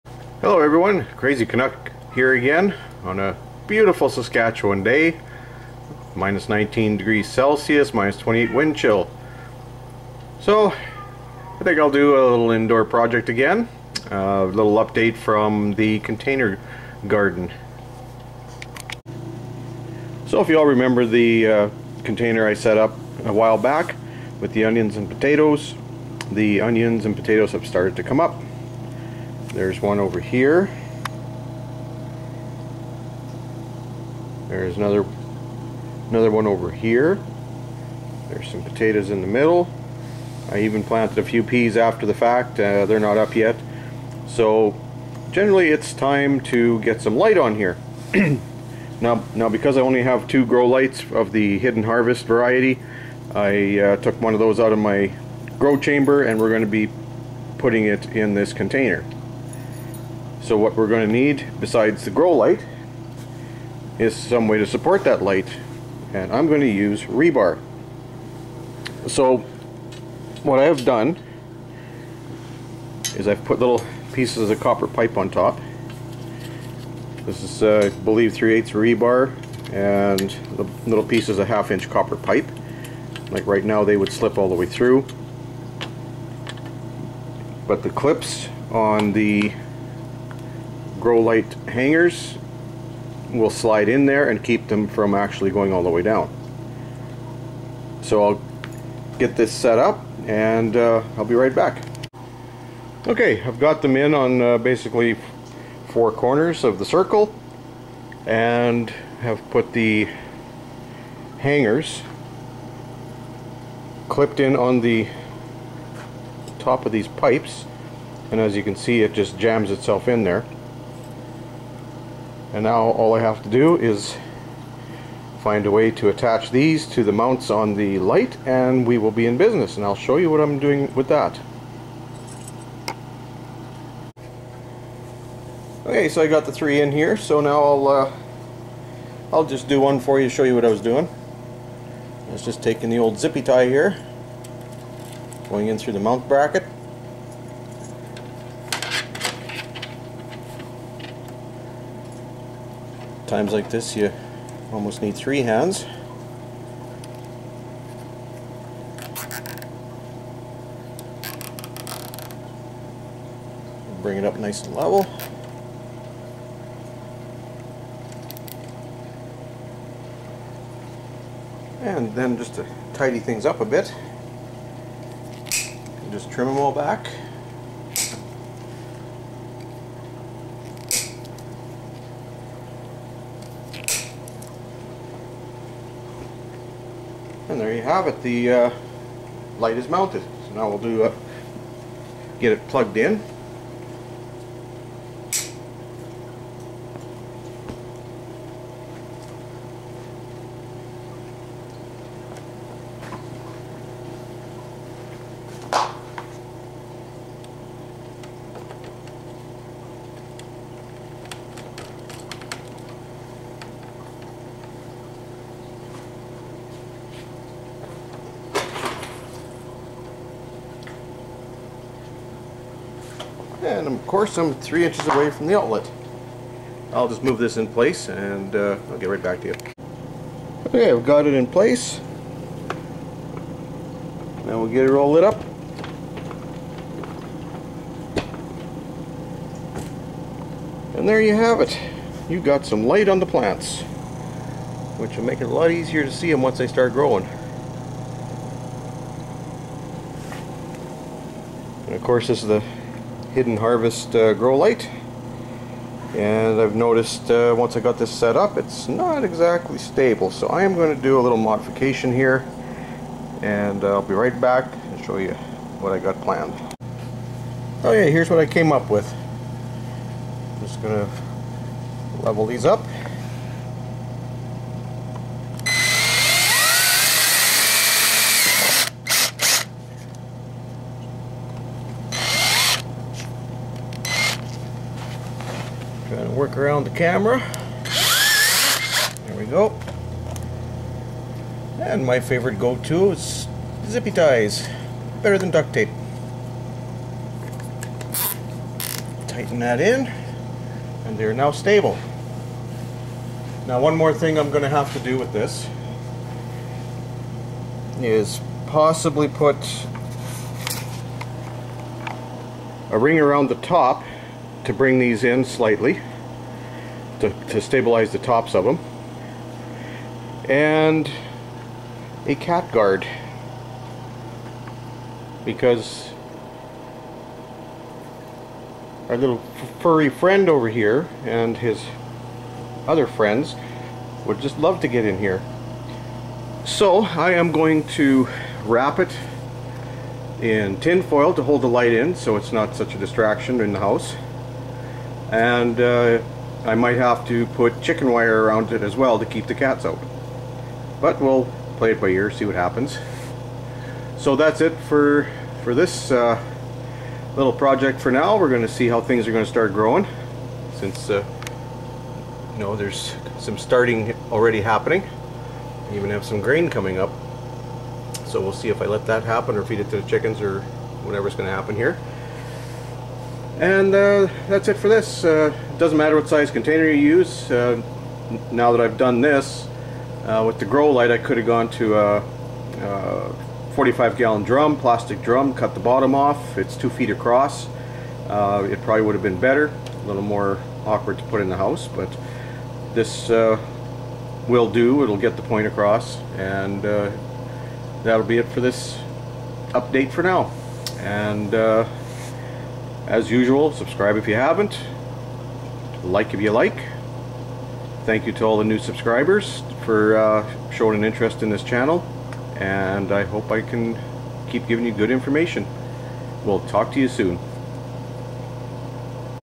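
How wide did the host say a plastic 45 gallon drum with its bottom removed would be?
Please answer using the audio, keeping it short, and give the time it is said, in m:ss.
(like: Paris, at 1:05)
2 feet, at 6:26.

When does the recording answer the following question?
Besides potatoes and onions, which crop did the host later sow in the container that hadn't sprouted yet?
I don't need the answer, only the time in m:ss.
0:41.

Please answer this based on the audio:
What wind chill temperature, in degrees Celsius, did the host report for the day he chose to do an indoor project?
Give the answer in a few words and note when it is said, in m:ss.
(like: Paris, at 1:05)
-28, at 0:07.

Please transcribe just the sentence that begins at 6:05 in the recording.
I even have some grain coming up.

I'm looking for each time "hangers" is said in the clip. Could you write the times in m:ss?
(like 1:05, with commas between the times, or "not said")
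1:31, 1:51.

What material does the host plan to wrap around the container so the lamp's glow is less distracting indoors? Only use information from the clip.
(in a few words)
Tin foil.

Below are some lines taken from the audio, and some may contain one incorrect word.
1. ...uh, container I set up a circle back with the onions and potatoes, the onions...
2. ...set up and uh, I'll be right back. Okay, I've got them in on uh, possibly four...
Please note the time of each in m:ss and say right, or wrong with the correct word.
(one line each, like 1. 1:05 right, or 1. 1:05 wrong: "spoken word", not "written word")
1. 0:21 wrong: "while", not "circle"
2. 1:39 wrong: "basically", not "possibly".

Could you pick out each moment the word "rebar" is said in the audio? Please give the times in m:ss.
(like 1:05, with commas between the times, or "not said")
1:07, 1:18.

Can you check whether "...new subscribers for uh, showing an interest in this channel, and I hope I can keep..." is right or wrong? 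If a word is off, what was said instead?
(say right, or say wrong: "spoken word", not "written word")
right.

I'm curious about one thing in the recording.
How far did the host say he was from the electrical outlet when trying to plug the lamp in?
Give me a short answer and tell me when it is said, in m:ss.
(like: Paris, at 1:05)
3 inches, at 3:44.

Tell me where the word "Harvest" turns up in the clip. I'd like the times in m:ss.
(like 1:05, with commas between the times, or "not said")
0:51, 4:13.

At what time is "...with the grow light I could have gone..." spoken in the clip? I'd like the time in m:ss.
6:20.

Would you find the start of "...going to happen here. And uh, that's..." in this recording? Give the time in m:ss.
6:11.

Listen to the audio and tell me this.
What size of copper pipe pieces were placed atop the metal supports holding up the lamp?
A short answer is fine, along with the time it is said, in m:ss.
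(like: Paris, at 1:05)
Half inch, at 1:21.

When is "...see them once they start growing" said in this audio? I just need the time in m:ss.
4:06.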